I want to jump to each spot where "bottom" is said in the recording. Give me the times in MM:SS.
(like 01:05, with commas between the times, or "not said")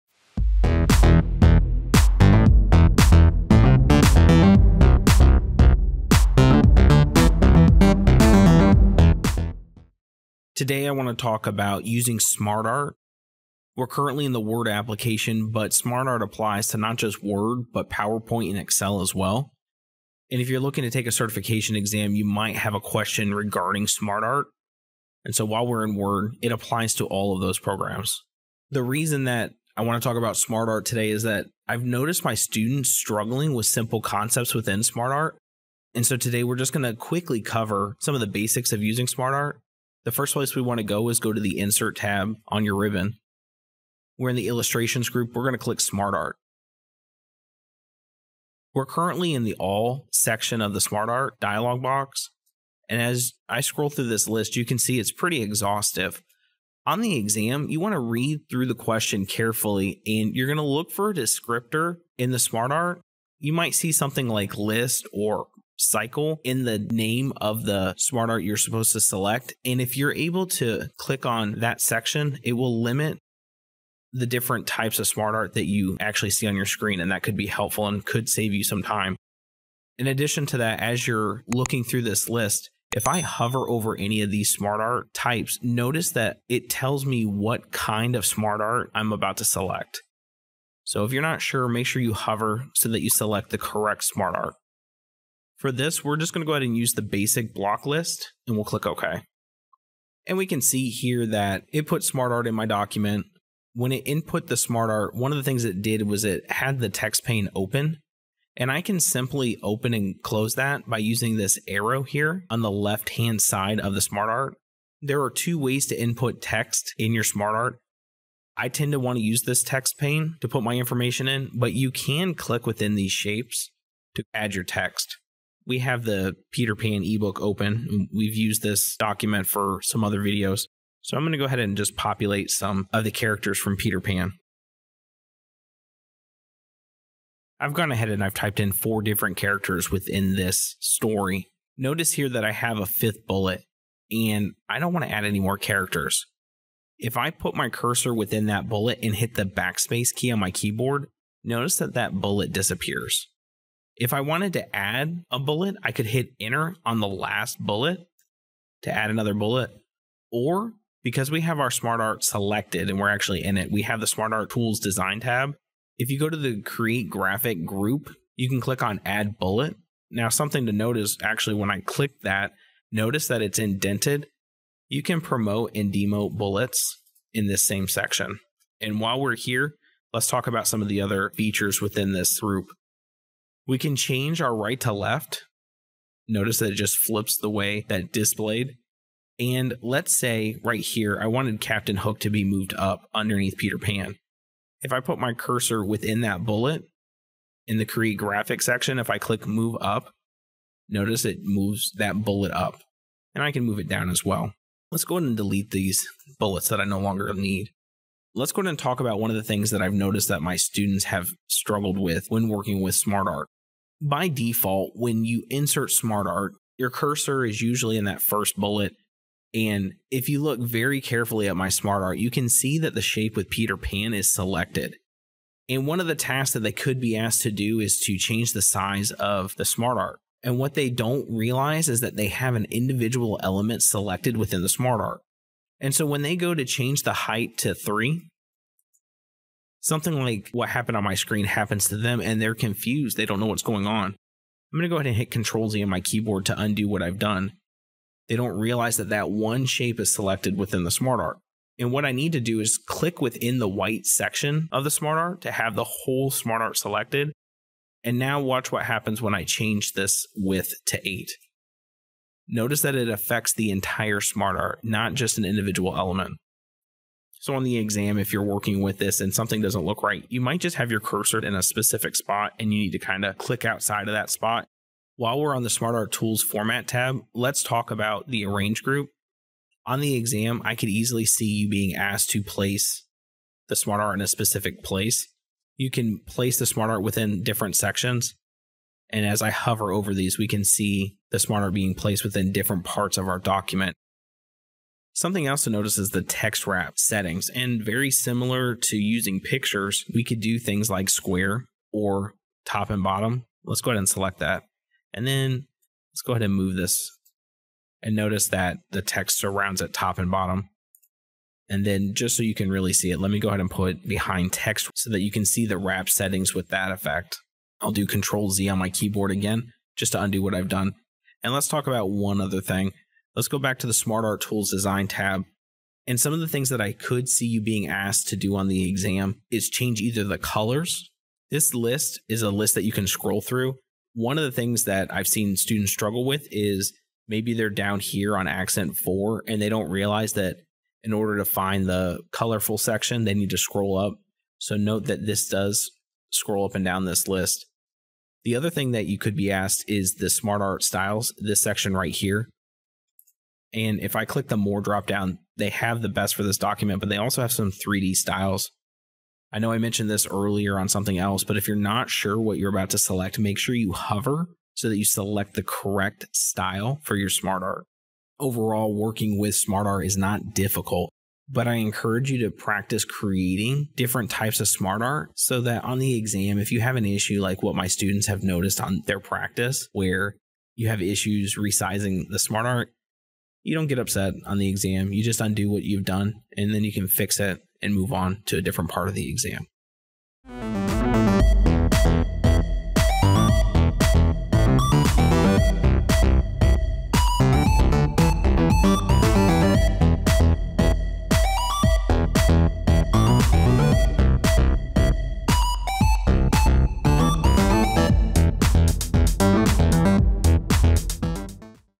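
05:03, 05:10.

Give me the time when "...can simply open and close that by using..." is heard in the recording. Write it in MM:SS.
01:48.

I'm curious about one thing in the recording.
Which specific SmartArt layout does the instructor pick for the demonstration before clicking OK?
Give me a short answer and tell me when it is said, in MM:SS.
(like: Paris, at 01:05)
Basic block list, at 01:37.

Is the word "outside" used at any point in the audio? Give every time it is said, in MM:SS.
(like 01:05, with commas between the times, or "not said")
04:33.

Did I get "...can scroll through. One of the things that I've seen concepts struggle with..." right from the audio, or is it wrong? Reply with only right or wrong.
wrong.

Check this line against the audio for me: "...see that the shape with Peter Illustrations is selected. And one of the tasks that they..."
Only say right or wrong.
wrong.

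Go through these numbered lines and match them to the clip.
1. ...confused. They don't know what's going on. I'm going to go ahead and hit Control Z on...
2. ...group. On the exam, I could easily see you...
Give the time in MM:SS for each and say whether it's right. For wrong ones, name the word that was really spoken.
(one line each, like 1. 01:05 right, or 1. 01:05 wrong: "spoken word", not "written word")
1. 04:02 right
2. 04:38 right.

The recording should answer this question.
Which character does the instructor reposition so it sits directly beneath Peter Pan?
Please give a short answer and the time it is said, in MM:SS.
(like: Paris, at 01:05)
Captain Hook, at 03:11.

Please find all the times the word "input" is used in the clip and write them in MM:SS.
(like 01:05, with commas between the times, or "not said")
01:44, 01:56.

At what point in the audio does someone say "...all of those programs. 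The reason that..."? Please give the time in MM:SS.
00:27.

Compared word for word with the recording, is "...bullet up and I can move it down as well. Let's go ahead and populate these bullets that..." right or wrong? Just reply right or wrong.
wrong.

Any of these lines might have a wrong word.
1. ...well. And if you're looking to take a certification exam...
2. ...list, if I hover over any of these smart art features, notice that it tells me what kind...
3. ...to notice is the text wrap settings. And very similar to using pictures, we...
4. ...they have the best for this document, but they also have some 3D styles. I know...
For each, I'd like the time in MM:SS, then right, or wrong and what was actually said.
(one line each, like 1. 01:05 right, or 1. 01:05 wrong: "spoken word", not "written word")
1. 00:19 right
2. 01:22 wrong: "types", not "features"
3. 04:55 right
4. 05:55 right.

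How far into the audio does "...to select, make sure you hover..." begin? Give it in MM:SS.
06:02.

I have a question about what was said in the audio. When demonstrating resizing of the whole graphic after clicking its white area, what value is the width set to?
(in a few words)
8.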